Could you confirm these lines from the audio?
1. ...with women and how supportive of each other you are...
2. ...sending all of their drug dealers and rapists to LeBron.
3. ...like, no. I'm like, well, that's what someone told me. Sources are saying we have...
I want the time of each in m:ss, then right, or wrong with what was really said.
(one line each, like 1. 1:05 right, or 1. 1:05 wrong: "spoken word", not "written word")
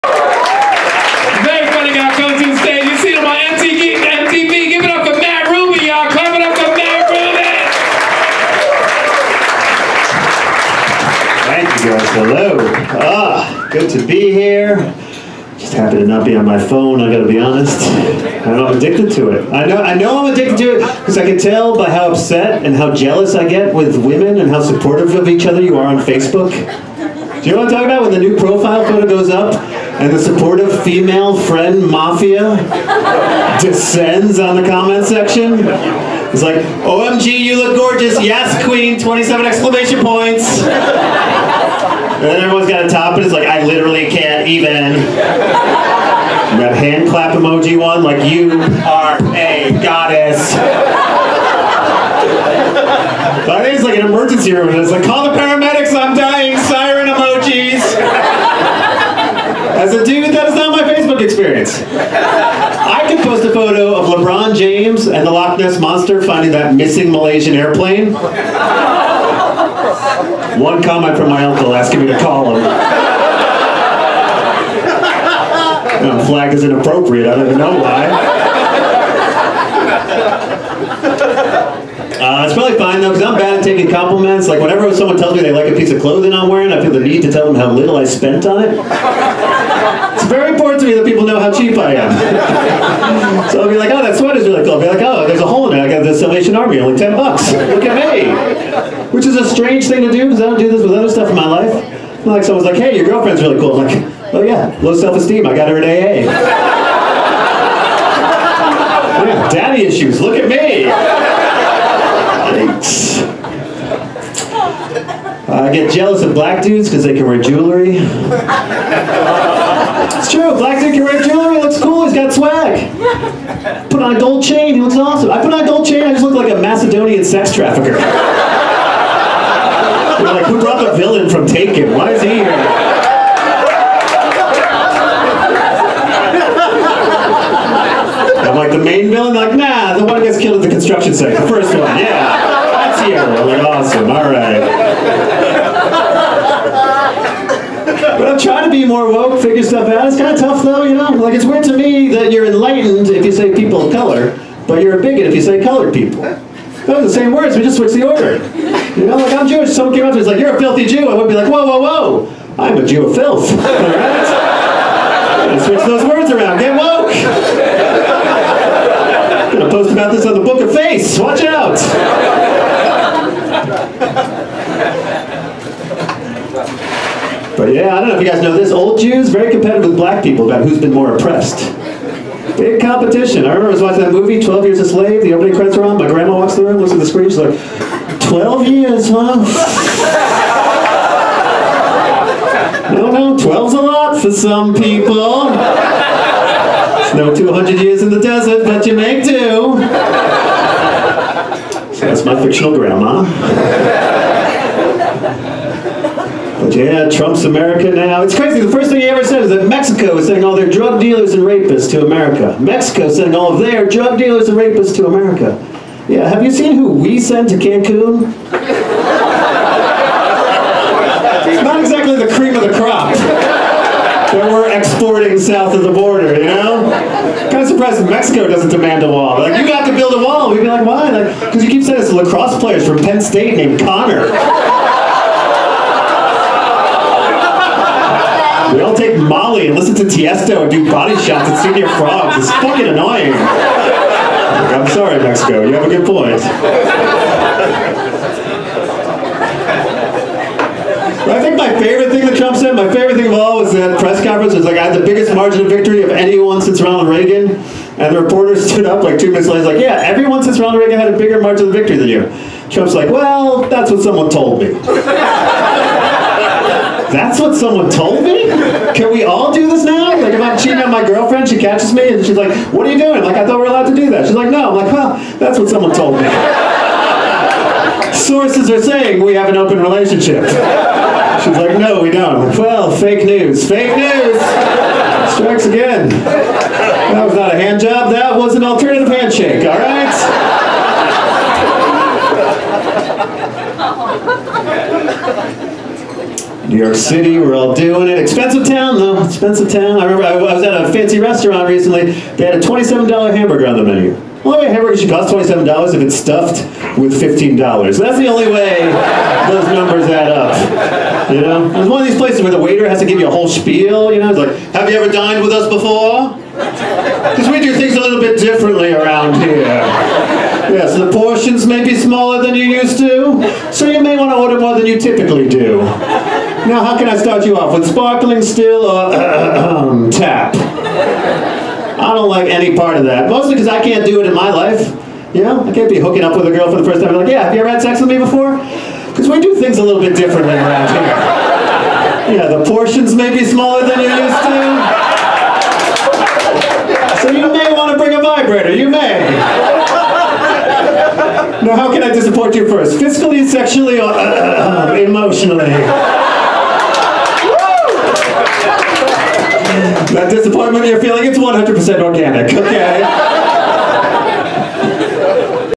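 1. 0:23 right
2. 3:33 wrong: "America", not "LeBron"
3. 4:34 right.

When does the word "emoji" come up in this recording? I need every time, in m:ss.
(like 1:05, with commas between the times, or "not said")
0:47, 0:57.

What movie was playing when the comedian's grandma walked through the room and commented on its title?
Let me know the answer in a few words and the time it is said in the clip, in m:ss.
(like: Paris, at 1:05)
12 Years a Slave, at 3:04.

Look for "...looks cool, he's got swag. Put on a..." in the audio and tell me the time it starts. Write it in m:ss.
2:01.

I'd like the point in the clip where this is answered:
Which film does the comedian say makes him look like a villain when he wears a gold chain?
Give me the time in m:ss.
2:11.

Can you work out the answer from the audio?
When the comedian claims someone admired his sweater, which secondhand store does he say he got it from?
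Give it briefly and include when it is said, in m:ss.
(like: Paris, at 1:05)
Salvation Army, at 1:36.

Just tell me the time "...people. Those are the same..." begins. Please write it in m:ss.
2:35.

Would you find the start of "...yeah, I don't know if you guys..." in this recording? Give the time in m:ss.
2:57.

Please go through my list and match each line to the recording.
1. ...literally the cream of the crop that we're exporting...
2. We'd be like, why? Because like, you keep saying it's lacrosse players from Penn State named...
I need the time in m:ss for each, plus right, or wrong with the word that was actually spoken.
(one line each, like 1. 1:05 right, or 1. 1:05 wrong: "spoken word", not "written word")
1. 3:41 wrong: "exactly", not "literally"
2. 3:50 right.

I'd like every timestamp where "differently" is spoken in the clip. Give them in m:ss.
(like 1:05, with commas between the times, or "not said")
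5:18, 5:40.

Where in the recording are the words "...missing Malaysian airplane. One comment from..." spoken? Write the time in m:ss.
1:06.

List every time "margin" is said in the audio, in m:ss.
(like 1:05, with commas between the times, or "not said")
4:15, 4:21.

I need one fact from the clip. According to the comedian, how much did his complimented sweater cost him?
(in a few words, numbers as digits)
$10.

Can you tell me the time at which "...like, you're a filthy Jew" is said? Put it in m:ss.
2:40.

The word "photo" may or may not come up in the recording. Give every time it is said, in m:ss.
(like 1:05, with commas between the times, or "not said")
0:28, 1:03.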